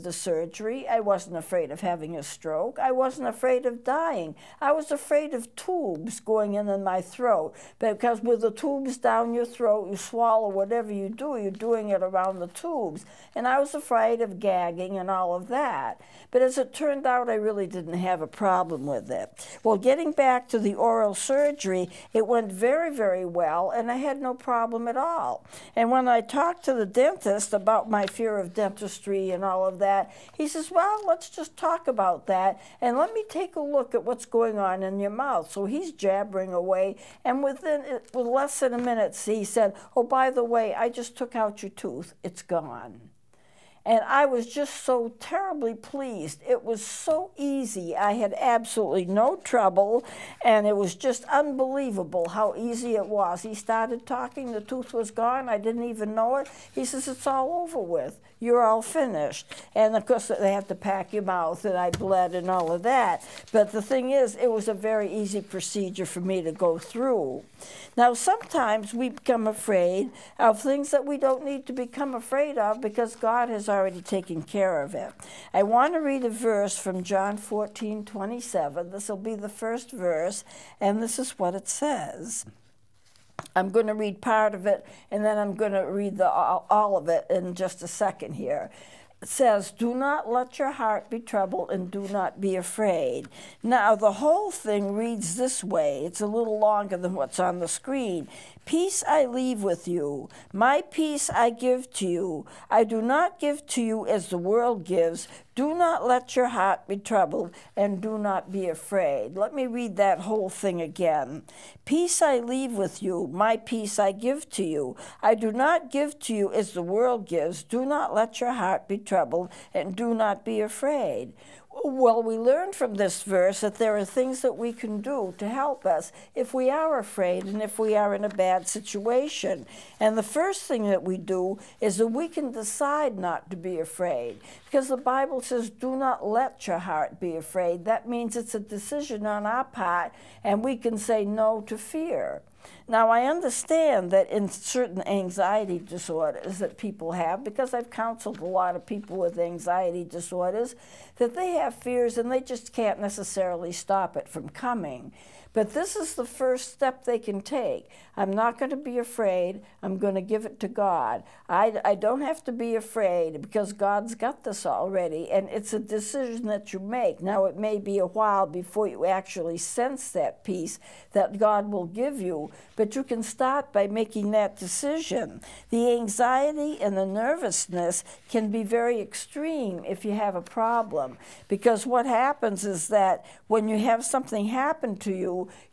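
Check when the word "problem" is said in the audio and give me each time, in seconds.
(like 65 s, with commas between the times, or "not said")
18 s, 24 s, 180 s.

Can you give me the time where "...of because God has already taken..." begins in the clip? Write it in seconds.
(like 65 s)
72 s.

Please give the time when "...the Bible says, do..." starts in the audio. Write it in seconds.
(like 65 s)
134 s.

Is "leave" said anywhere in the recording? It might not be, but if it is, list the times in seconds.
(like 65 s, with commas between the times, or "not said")
99 s, 112 s.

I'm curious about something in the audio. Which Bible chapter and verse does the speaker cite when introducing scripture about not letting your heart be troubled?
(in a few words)
John 14:27.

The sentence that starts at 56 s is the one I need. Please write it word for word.
He says, It's all over with you're all finished.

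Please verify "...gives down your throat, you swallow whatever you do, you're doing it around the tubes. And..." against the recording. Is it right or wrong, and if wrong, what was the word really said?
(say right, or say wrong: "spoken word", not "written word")
wrong: "tubes", not "gives".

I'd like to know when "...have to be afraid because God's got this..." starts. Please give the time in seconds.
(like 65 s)
162 s.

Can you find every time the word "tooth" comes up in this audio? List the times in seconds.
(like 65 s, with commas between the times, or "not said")
41 s, 54 s.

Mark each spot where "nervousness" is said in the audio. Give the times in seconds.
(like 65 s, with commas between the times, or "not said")
177 s.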